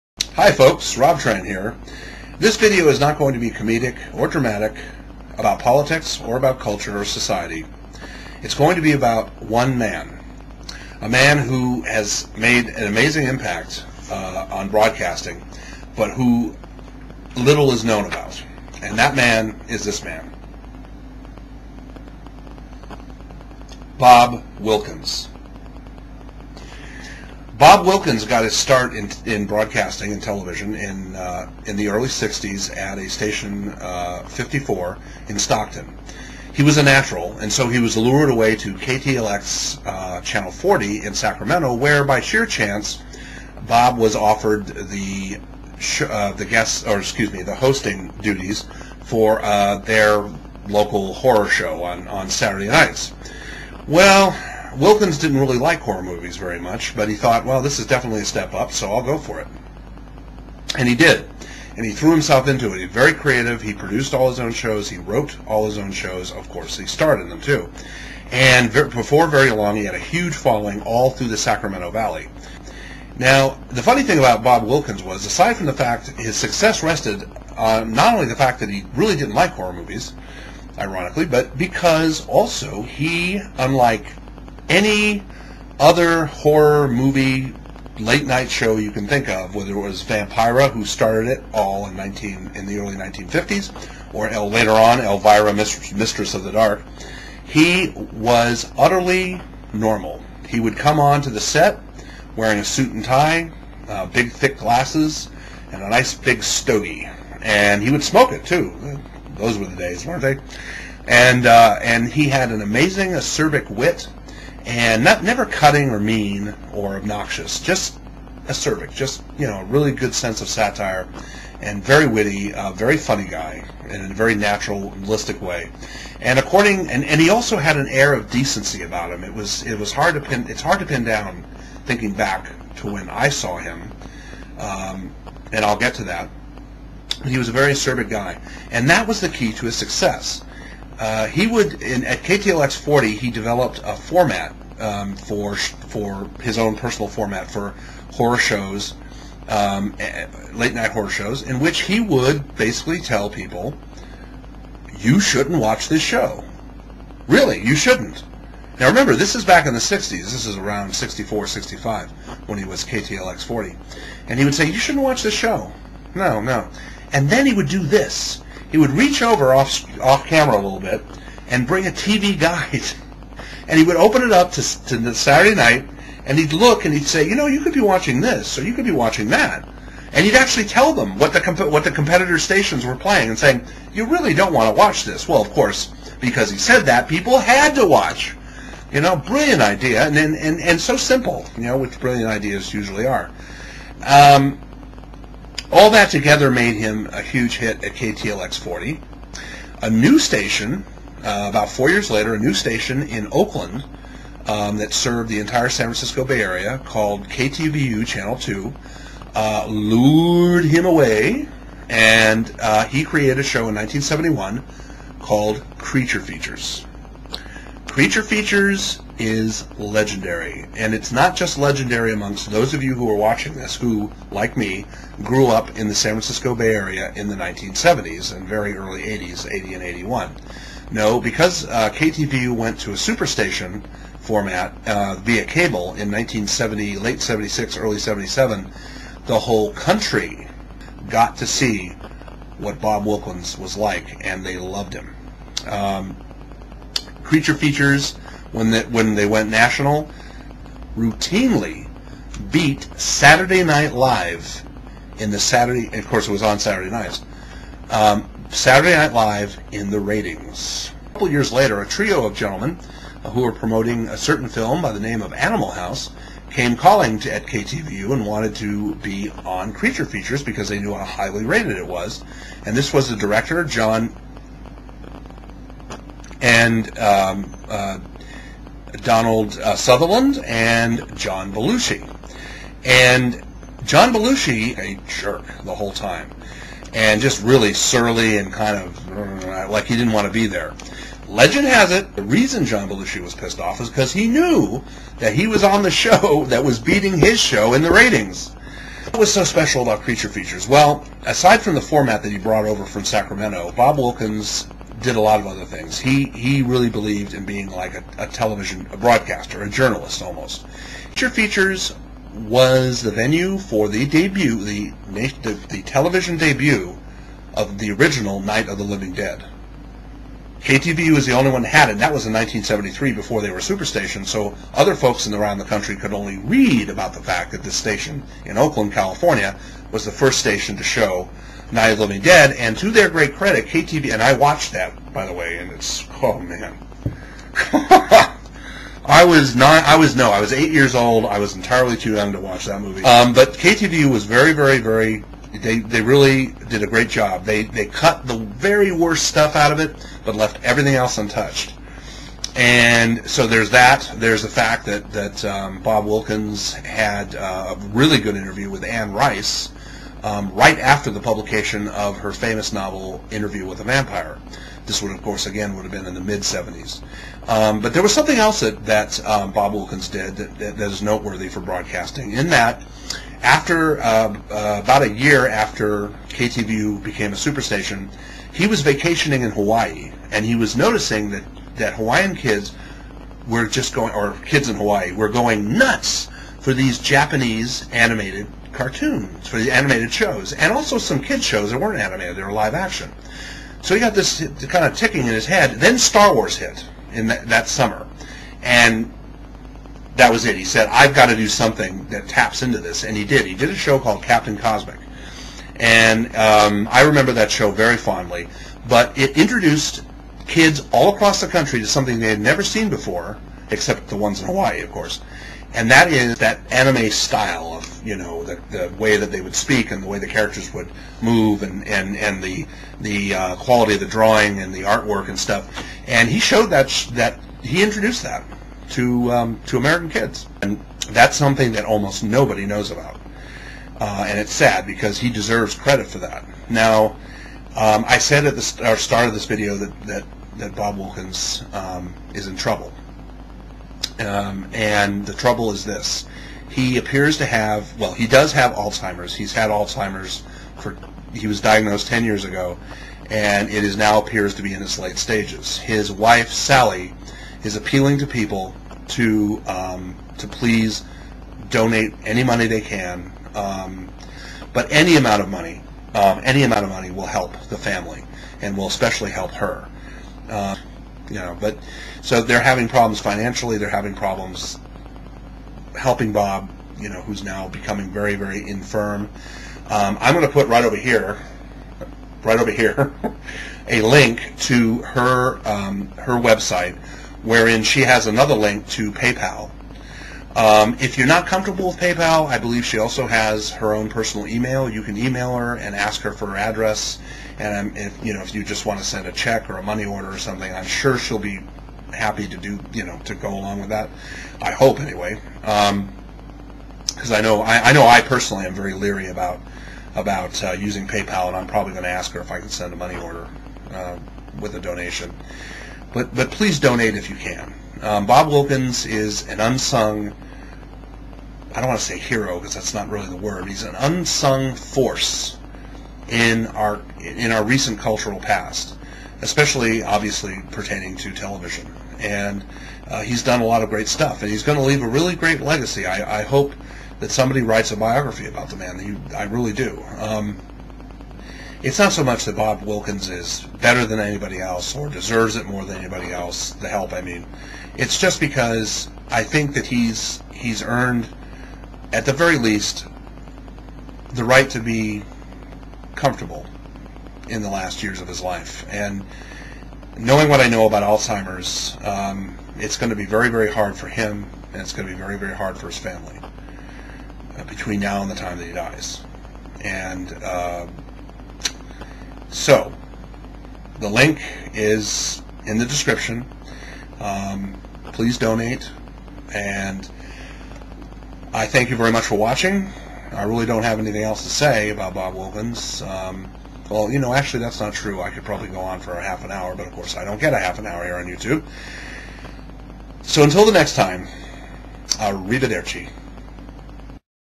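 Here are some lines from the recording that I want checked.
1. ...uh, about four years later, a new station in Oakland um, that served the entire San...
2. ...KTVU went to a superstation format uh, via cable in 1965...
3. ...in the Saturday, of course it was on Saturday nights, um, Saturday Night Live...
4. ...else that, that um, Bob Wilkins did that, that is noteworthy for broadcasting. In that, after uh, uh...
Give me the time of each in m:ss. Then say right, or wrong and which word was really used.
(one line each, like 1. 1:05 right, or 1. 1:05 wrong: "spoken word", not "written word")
1. 3:21 right
2. 3:51 wrong: "1970", not "1965"
3. 4:15 right
4. 6:08 right.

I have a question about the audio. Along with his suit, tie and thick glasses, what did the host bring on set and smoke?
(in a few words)
stogie.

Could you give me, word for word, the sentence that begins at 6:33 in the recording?
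So he got this kind of ticking in his head.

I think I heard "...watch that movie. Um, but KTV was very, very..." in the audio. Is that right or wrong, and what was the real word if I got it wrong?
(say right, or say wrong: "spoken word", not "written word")
right.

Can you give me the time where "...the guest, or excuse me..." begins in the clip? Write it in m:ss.
0:46.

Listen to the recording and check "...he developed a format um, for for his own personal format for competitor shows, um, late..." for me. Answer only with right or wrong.
wrong.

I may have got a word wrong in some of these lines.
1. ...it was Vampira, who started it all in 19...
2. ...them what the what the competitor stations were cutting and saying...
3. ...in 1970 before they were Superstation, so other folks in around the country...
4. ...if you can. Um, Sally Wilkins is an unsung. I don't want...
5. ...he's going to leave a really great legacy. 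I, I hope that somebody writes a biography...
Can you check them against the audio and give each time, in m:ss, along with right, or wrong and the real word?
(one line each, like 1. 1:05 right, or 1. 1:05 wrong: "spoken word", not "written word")
1. 1:29 right
2. 3:00 wrong: "playing", not "cutting"
3. 5:22 wrong: "1973", not "1970"
4. 8:37 wrong: "Bob", not "Sally"
5. 8:54 right.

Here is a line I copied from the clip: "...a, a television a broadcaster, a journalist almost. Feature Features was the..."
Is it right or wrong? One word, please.
right.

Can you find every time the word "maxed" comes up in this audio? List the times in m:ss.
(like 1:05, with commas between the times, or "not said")
not said.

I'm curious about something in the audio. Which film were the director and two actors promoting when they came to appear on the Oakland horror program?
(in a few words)
Animal House.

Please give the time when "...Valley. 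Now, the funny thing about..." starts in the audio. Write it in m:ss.
1:11.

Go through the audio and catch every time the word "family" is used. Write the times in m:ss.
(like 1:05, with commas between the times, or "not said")
7:47, 9:25.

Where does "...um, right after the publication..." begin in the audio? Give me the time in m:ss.
6:00.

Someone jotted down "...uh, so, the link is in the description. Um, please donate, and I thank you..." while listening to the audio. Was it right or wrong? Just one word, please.
right.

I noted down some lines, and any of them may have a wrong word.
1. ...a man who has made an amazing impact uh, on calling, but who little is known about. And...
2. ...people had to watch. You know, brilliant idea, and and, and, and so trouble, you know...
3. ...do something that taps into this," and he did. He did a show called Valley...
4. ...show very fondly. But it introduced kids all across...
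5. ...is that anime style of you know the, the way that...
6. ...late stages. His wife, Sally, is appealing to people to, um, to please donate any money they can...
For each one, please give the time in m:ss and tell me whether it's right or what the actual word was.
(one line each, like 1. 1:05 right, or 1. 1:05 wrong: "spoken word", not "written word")
1. 0:11 wrong: "broadcasting", not "calling"
2. 3:07 wrong: "simple", not "trouble"
3. 6:41 wrong: "Captain", not "Valley"
4. 6:47 right
5. 6:56 right
6. 7:34 right.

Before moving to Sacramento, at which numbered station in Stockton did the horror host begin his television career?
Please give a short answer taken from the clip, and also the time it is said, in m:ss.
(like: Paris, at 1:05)
54, at 0:34.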